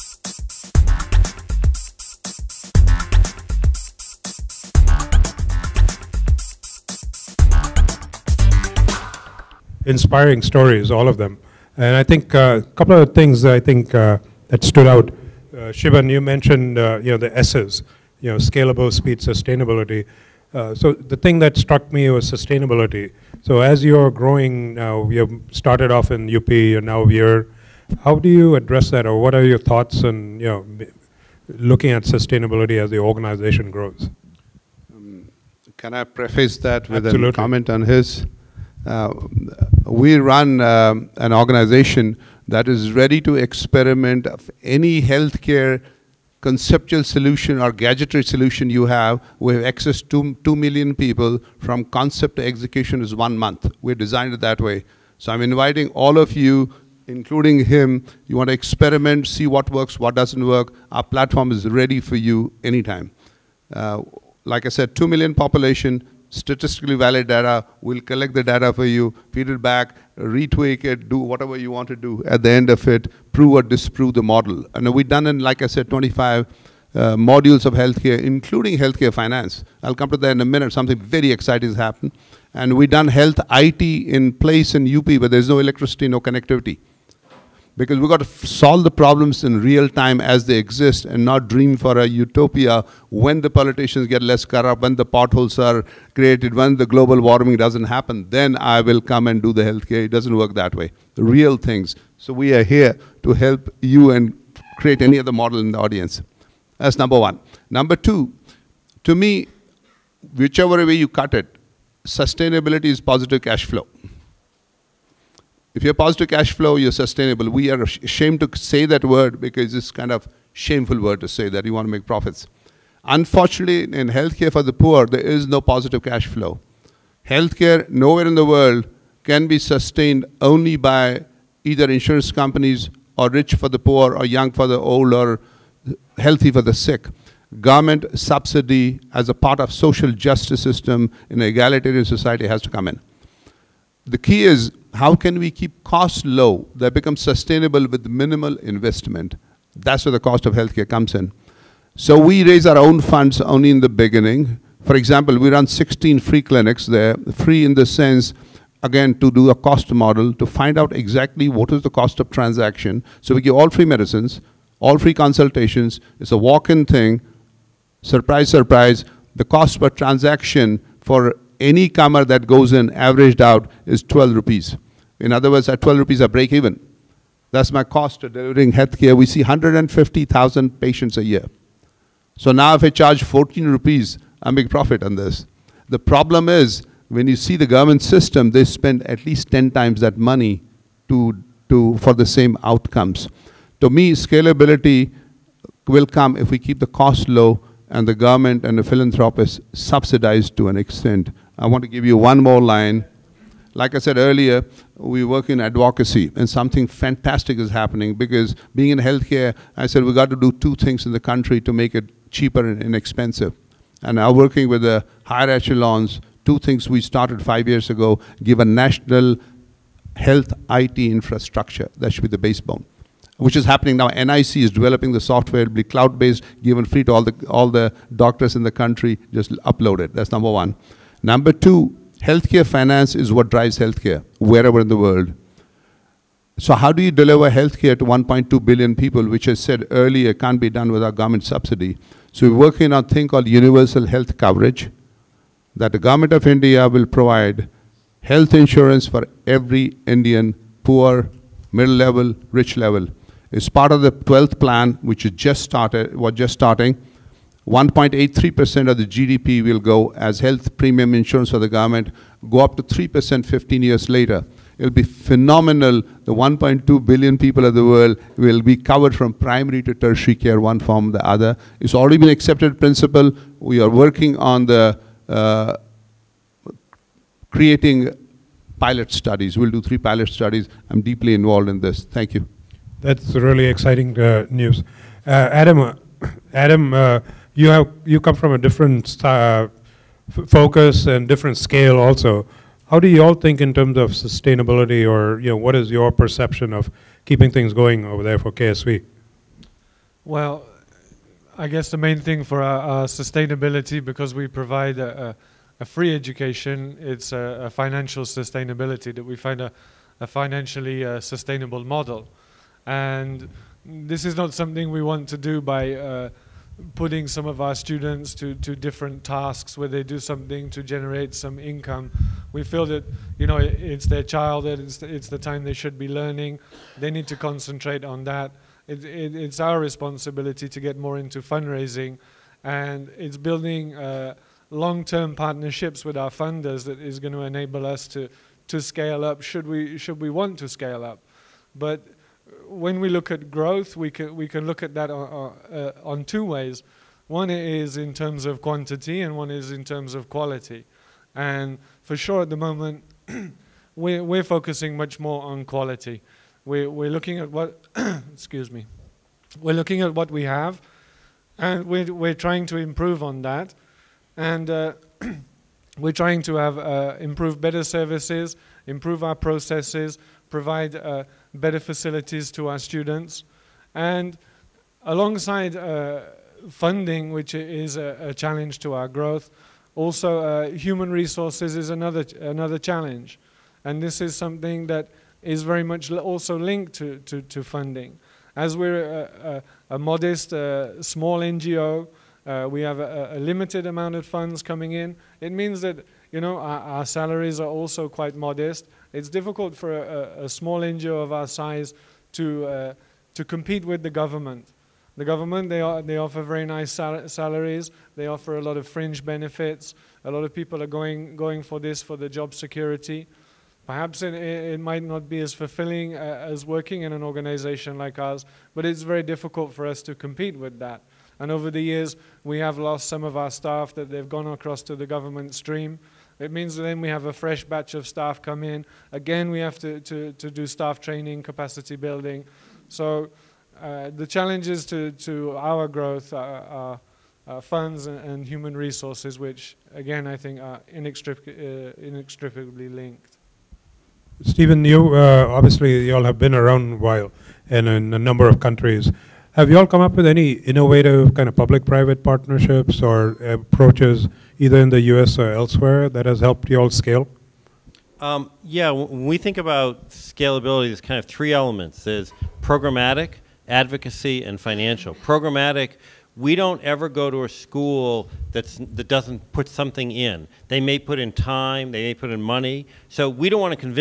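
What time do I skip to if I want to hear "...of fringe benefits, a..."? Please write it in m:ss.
6:48.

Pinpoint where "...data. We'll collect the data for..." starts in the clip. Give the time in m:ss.
1:07.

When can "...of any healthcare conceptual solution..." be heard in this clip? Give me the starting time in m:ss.
0:44.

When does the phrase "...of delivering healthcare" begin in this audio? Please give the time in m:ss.
2:58.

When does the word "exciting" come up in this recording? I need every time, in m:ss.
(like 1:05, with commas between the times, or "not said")
1:21, 4:43.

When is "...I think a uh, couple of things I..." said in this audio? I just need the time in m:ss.
0:11.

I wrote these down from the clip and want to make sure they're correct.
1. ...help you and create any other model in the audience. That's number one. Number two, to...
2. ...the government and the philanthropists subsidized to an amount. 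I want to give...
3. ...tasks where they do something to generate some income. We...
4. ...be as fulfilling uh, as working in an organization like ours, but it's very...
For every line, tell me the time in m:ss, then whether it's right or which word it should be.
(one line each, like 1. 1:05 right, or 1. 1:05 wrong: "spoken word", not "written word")
1. 1:43 right
2. 3:18 wrong: "extent", not "amount"
3. 5:19 right
4. 6:55 right.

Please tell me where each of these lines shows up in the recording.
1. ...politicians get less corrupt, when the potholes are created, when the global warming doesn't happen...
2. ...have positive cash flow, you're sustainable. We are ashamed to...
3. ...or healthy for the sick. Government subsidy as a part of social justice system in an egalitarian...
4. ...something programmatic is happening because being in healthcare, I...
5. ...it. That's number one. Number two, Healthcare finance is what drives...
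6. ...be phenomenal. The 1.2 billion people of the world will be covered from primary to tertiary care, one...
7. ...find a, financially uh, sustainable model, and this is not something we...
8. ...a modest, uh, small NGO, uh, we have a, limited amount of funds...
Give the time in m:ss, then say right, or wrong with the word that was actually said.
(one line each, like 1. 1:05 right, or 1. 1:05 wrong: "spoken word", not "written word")
1. 1:33 right
2. 1:55 right
3. 2:15 right
4. 3:26 wrong: "fantastic", not "programmatic"
5. 3:50 right
6. 4:24 right
7. 5:09 right
8. 6:29 right.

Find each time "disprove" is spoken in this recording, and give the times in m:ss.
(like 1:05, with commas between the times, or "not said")
1:13.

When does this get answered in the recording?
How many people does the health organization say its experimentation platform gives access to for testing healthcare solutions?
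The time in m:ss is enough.
0:50.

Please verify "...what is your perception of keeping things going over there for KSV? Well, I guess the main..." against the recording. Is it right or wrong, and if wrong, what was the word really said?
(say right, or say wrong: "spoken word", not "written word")
right.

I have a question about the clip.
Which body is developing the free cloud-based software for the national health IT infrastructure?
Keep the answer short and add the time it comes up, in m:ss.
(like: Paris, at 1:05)
NIC, at 3:44.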